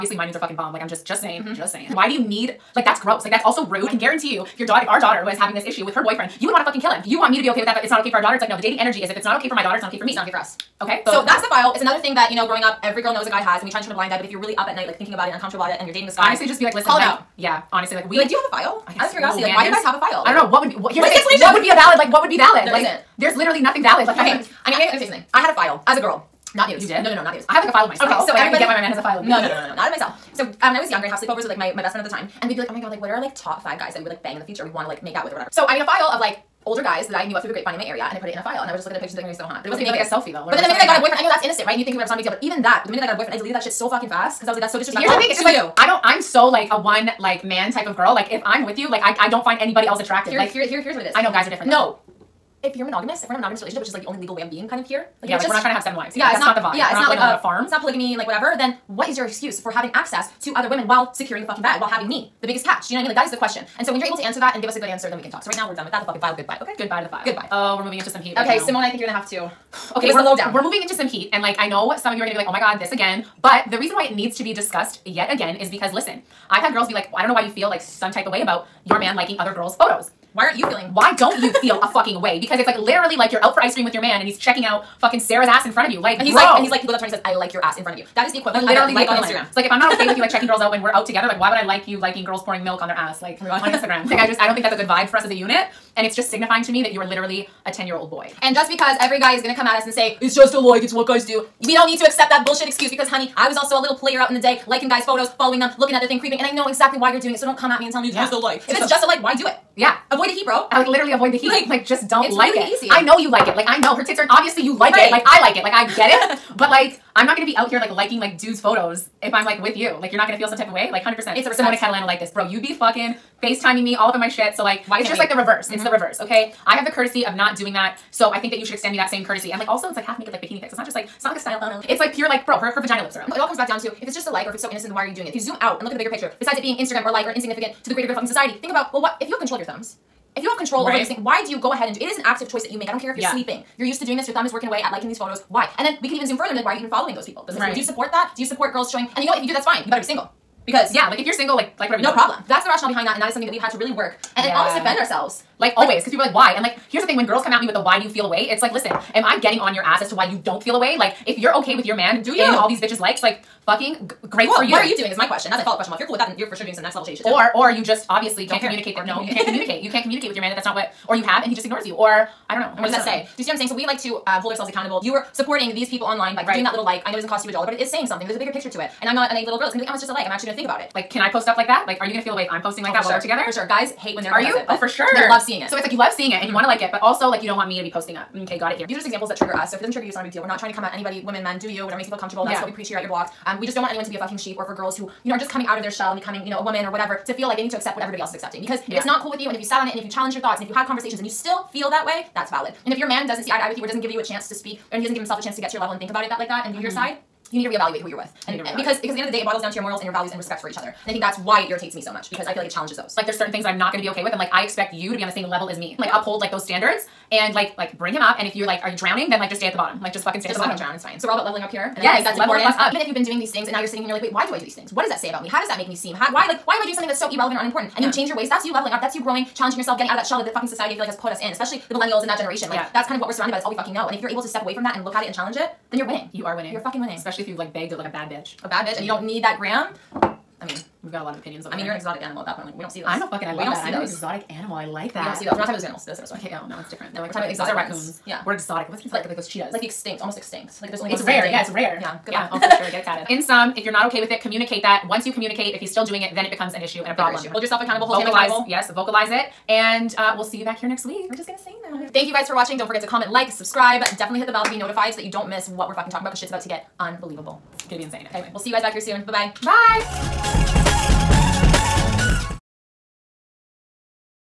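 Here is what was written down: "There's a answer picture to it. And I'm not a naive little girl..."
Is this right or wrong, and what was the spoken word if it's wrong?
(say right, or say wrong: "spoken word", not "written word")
wrong: "bigger", not "answer".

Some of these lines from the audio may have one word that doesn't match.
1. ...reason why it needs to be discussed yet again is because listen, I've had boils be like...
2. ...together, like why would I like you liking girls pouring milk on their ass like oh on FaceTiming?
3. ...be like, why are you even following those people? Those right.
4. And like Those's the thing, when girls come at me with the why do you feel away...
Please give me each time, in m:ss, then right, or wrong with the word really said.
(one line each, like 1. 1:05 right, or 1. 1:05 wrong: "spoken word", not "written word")
1. 1:13 wrong: "girls", not "boils"
2. 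1:31 wrong: "Instagram", not "FaceTiming"
3. 2:26 right
4. 2:36 wrong: "Here", not "Those".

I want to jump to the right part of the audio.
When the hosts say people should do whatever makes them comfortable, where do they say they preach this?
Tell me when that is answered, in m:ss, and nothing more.
3:13.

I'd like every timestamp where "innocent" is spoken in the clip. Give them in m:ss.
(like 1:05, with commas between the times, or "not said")
0:41, 2:14.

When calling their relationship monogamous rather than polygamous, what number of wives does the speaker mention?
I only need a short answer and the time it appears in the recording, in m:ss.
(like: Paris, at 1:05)
7, at 0:55.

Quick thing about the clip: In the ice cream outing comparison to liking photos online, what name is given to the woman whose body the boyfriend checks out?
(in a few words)
Sarah.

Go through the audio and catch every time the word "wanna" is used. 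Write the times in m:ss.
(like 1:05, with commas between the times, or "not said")
3:06.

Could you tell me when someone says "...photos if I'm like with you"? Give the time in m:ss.
1:58.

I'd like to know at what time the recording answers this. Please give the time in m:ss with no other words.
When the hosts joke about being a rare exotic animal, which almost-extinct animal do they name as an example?
4:09.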